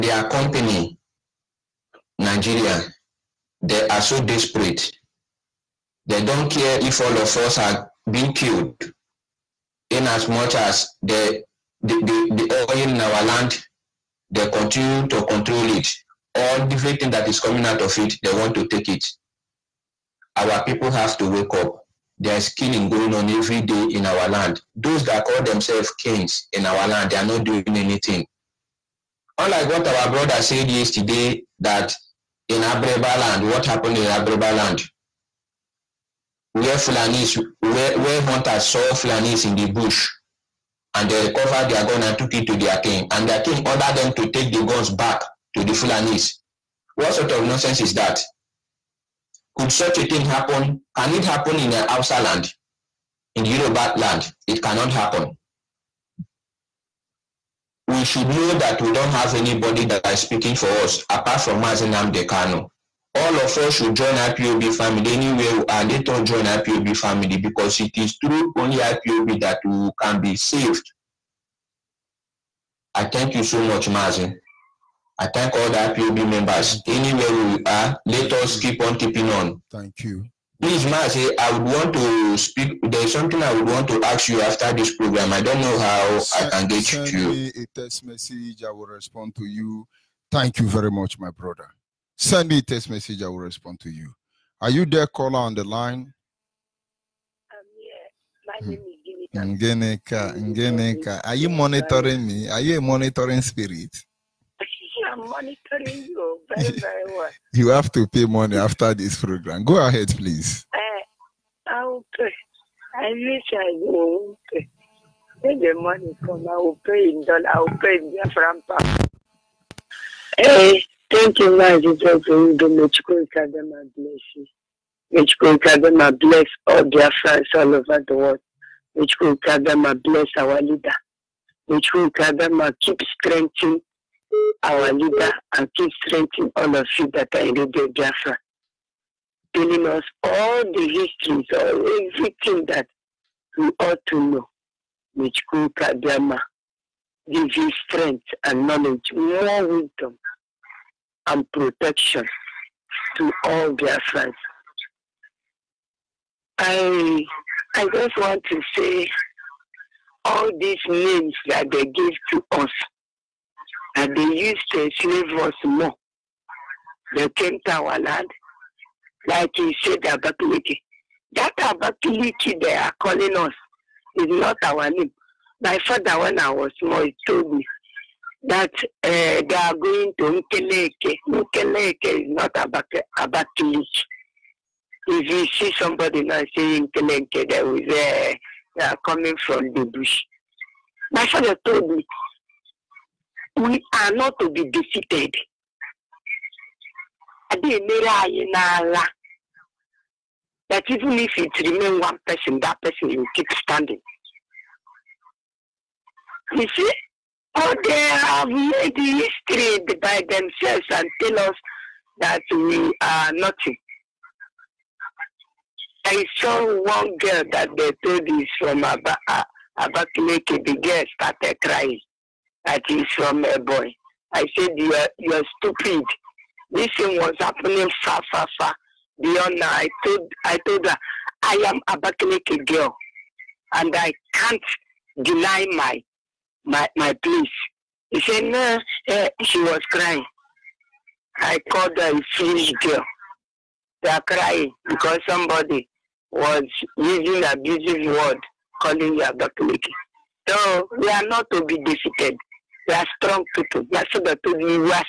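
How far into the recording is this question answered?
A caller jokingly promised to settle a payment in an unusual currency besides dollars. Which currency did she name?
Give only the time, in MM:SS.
01:58.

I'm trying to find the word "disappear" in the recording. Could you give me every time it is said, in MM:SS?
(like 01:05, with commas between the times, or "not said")
not said.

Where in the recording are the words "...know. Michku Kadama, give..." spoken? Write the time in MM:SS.
02:24.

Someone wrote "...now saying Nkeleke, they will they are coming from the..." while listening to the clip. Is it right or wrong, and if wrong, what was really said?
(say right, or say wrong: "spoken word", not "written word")
right.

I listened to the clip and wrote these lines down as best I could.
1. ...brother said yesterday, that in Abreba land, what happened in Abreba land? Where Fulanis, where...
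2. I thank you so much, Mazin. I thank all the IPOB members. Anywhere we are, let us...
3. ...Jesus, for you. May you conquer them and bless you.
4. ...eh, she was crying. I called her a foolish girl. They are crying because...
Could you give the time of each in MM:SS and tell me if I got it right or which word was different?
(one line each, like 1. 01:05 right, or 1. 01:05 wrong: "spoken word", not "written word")
1. 00:30 right
2. 01:12 right
3. 02:01 right
4. 03:59 right.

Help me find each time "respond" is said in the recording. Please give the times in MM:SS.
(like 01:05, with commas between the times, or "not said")
01:28, 01:33.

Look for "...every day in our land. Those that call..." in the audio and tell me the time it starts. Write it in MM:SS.
00:23.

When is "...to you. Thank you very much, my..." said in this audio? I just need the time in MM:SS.
01:29.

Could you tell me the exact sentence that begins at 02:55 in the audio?
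My father, when I was small, he told me that uh, they are going to Nkeleke.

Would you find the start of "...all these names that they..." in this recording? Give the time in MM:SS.
02:40.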